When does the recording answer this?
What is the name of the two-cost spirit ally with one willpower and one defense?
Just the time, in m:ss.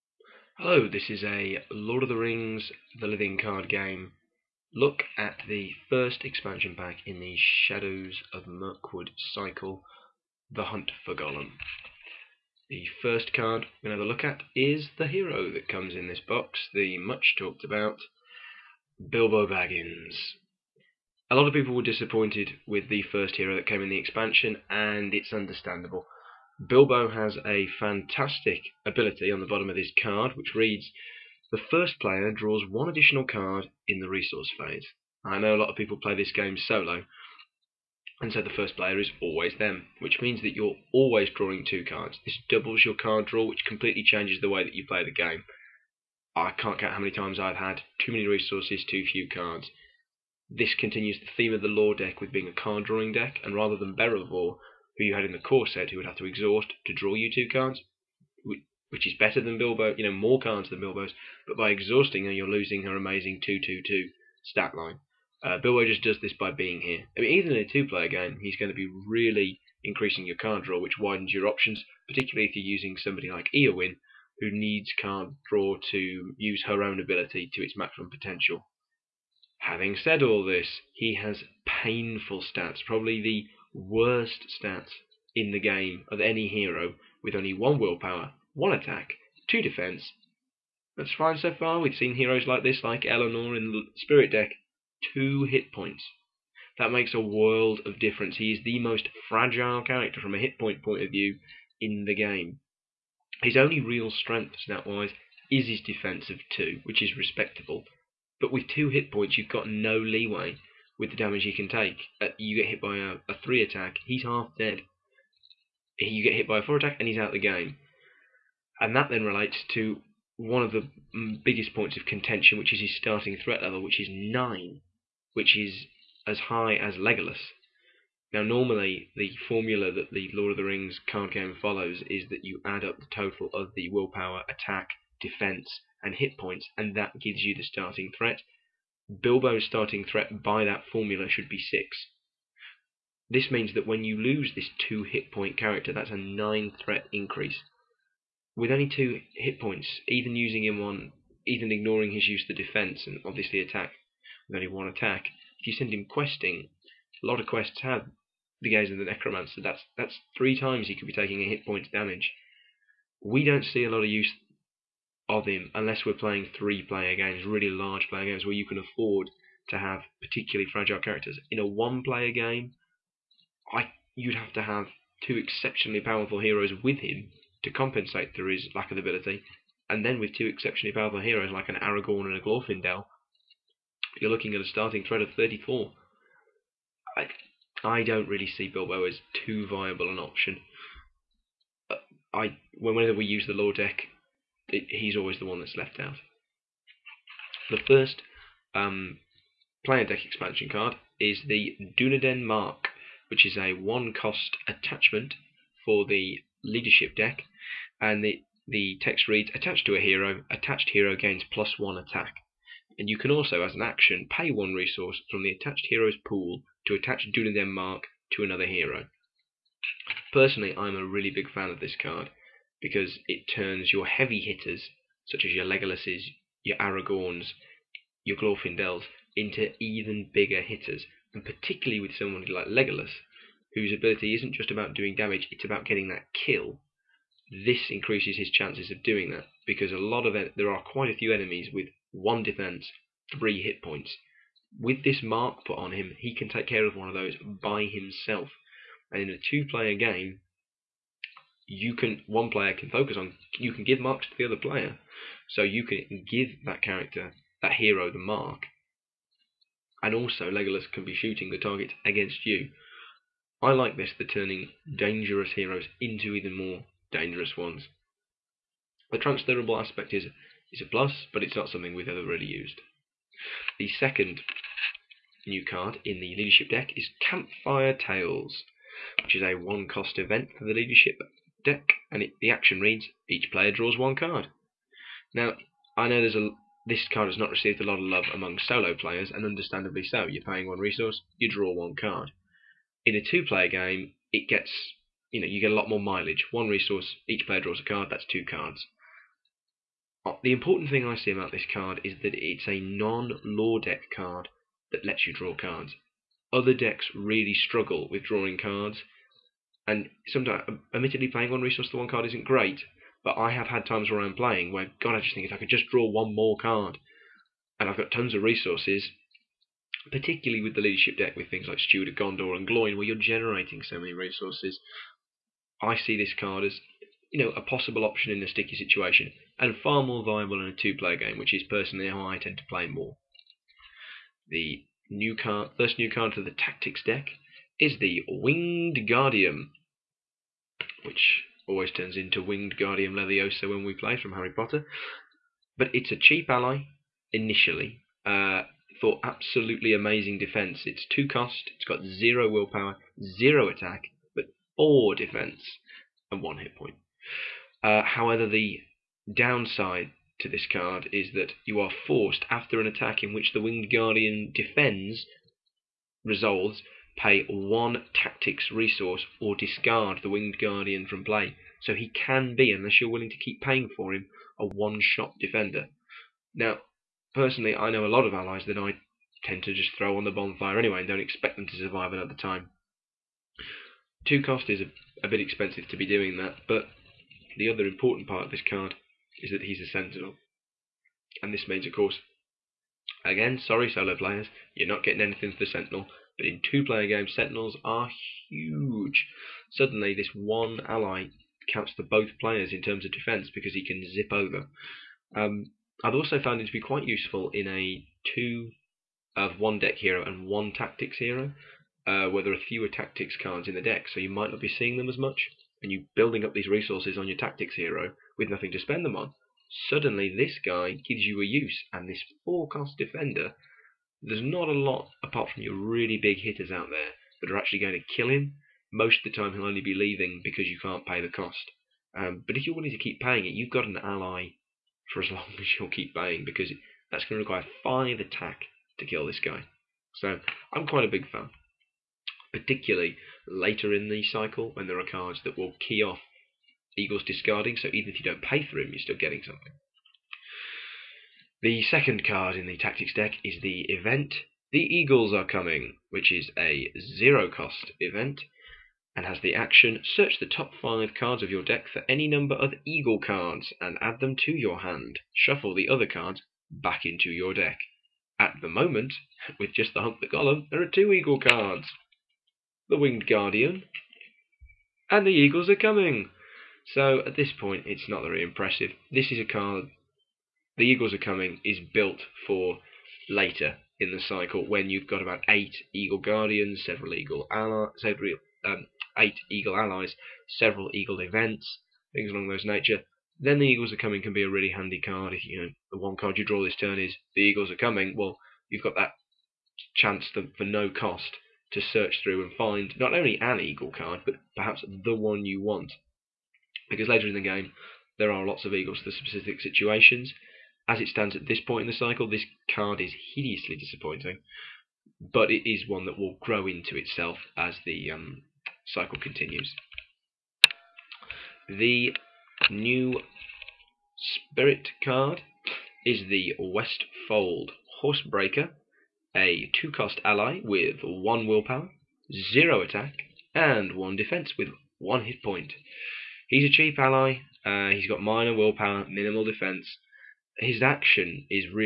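8:46.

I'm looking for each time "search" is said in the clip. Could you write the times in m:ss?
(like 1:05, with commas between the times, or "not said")
7:40, 8:21.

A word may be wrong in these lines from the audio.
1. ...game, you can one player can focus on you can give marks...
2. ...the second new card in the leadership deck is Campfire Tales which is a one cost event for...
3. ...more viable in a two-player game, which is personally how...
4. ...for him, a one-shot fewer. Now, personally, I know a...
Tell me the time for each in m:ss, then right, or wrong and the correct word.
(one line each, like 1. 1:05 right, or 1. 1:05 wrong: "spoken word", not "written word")
1. 4:09 right
2. 4:33 right
3. 5:30 right
4. 6:13 wrong: "defender", not "fewer".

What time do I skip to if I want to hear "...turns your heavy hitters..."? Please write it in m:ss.
3:43.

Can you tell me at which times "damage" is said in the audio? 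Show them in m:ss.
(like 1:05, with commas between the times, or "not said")
1:51, 2:41, 3:55.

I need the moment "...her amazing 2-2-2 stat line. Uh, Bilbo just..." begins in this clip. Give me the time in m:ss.
1:02.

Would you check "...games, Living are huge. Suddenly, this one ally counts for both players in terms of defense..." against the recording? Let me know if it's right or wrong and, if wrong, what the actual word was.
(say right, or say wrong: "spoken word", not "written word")
wrong: "Sentinels", not "Living".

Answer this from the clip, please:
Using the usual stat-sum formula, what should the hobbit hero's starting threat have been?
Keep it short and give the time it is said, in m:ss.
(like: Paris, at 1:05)
6, at 2:21.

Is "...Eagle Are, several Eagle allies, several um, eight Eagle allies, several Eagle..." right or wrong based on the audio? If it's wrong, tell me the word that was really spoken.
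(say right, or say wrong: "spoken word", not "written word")
wrong: "Guardians", not "Are".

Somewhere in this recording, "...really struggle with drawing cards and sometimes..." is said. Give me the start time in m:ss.
5:07.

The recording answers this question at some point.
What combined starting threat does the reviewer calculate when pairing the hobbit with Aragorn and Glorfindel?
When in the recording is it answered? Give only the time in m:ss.
3:05.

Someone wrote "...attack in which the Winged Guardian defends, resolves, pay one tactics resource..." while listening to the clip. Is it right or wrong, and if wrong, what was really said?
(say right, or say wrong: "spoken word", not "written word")
right.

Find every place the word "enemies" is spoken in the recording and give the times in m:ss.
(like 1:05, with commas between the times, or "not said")
4:01.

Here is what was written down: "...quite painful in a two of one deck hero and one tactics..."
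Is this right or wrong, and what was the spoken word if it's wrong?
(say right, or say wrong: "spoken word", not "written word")
wrong: "useful", not "painful".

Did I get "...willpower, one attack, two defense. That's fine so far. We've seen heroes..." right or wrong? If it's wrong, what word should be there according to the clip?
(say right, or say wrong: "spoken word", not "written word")
right.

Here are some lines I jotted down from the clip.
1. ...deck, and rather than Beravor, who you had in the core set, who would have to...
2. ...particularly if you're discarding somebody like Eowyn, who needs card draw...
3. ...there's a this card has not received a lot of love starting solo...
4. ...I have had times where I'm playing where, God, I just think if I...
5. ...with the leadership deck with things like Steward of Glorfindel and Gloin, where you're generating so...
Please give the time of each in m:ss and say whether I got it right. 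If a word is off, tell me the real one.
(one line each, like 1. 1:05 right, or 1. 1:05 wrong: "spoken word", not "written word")
1. 0:53 right
2. 1:12 wrong: "using", not "discarding"
3. 4:46 wrong: "among", not "starting"
4. 5:13 right
5. 5:20 wrong: "Gondor", not "Glorfindel".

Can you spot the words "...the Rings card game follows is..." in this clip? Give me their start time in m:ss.
2:10.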